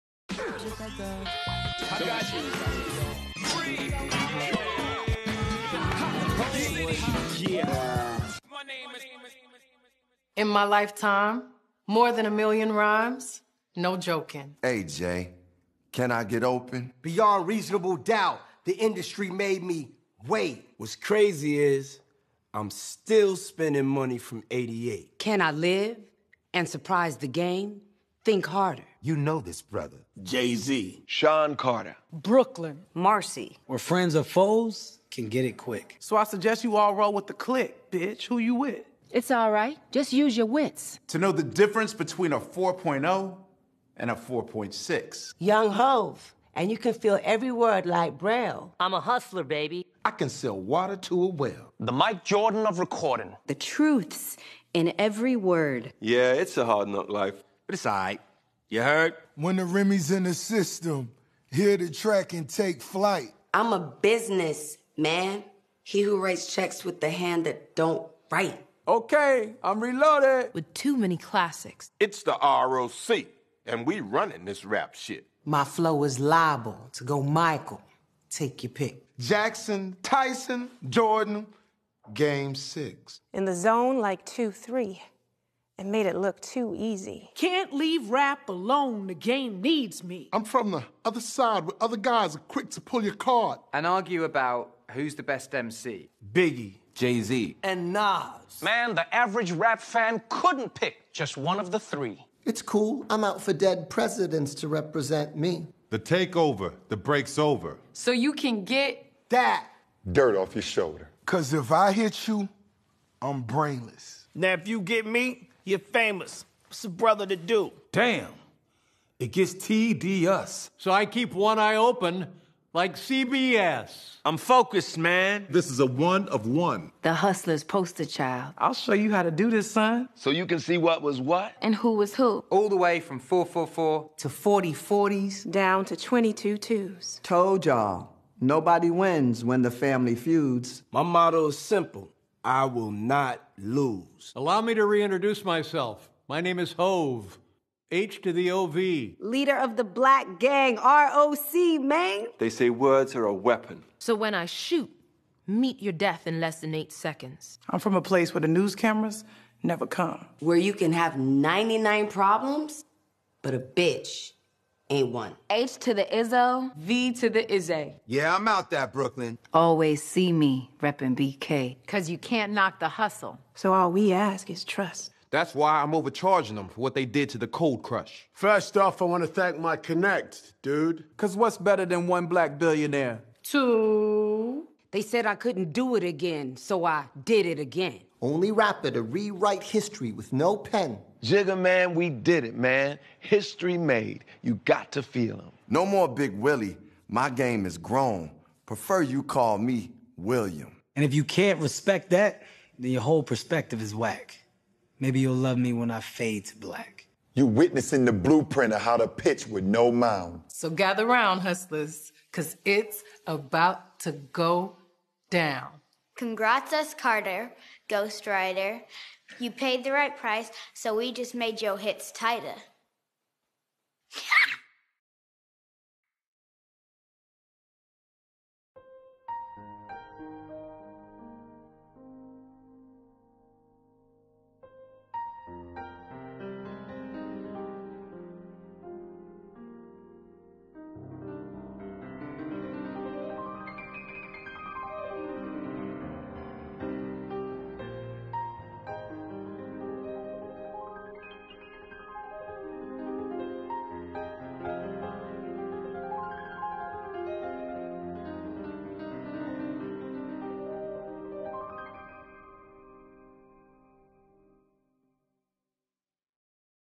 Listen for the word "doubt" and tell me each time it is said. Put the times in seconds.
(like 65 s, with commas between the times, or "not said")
17 s.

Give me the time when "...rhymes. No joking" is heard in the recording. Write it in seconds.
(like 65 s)
12 s.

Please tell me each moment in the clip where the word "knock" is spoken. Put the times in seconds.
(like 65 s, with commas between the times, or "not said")
56 s, 172 s.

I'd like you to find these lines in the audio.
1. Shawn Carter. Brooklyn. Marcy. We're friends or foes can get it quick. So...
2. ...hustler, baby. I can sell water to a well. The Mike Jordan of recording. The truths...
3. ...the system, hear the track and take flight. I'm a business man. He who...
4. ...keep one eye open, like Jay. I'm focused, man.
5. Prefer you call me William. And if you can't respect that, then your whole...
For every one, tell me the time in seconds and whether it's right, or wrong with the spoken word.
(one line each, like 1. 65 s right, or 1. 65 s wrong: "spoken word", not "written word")
1. 31 s right
2. 49 s right
3. 60 s right
4. 121 s wrong: "CBS", not "Jay"
5. 198 s right.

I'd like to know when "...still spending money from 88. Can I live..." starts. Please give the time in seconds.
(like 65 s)
22 s.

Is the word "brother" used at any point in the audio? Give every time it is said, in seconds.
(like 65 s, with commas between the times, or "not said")
29 s, 116 s.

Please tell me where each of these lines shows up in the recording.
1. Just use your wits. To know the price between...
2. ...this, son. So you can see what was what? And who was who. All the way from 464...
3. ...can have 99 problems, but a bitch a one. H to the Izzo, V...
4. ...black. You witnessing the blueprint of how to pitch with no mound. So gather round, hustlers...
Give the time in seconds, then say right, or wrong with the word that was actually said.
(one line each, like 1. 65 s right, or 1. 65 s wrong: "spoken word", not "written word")
1. 39 s wrong: "difference", not "price"
2. 129 s wrong: "444", not "464"
3. 160 s right
4. 206 s right.